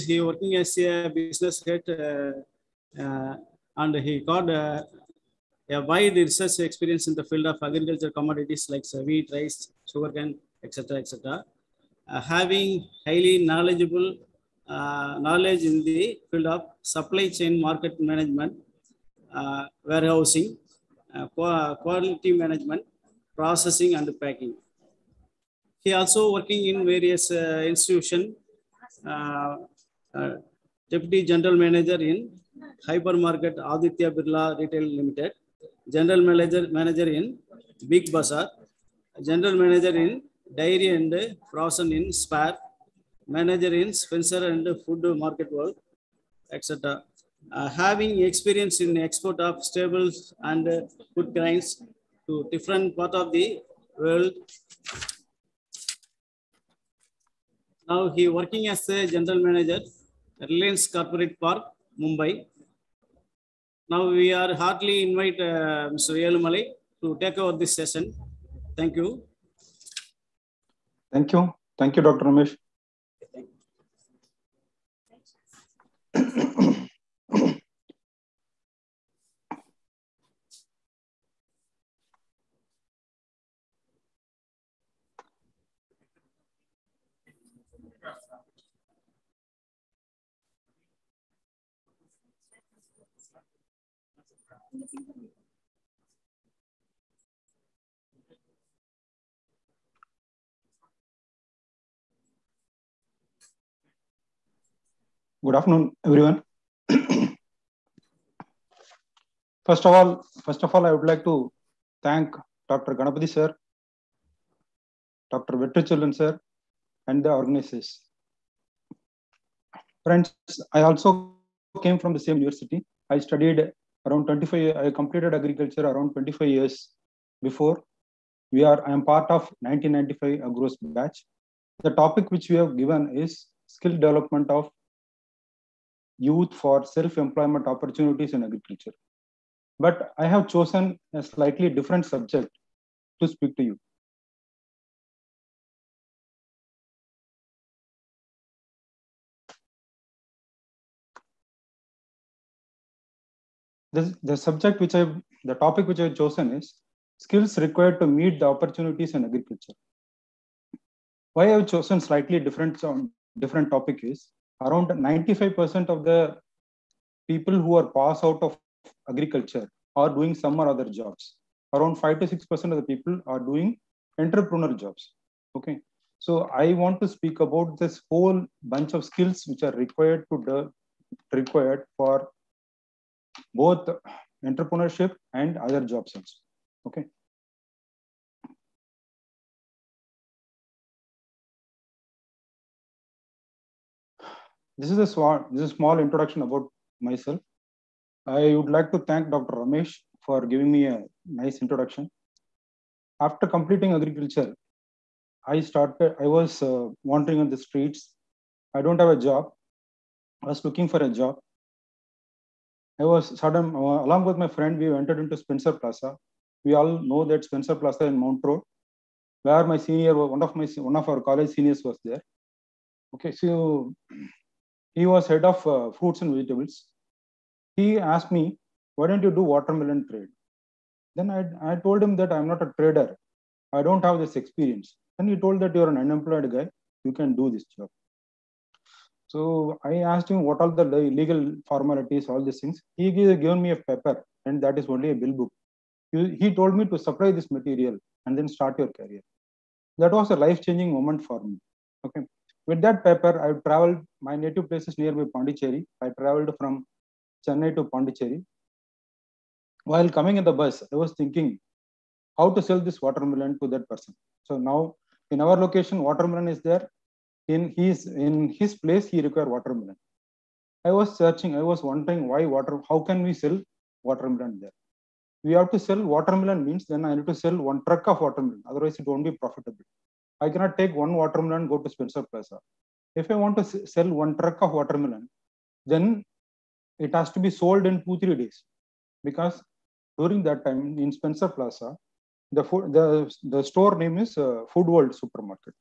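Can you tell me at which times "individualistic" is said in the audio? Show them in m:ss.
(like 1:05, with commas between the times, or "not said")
not said.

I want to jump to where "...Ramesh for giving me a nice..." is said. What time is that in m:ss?
3:19.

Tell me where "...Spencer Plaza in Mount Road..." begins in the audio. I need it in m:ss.
3:37.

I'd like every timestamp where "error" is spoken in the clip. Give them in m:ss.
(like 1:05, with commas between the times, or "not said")
not said.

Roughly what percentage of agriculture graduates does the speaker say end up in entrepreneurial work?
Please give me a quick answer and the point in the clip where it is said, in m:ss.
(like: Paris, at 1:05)
5 to 6%, at 2:51.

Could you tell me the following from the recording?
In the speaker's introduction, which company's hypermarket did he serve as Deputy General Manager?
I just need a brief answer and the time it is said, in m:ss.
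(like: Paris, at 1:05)
Aditya Birla Retail Limited, at 0:33.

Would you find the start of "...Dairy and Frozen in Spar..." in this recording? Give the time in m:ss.
0:40.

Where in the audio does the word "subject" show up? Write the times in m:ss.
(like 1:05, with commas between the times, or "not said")
2:22, 2:34.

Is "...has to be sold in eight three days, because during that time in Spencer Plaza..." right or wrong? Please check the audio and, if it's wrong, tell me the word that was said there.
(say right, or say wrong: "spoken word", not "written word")
wrong: "two", not "eight".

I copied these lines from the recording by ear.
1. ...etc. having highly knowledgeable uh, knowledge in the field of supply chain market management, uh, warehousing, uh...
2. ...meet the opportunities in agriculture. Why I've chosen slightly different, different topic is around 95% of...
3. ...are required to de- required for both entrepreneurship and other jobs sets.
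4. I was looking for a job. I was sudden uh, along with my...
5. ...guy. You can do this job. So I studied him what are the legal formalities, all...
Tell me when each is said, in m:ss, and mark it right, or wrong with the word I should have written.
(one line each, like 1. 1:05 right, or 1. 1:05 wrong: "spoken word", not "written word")
1. 0:10 right
2. 2:38 right
3. 2:59 right
4. 3:30 right
5. 3:56 wrong: "asked", not "studied".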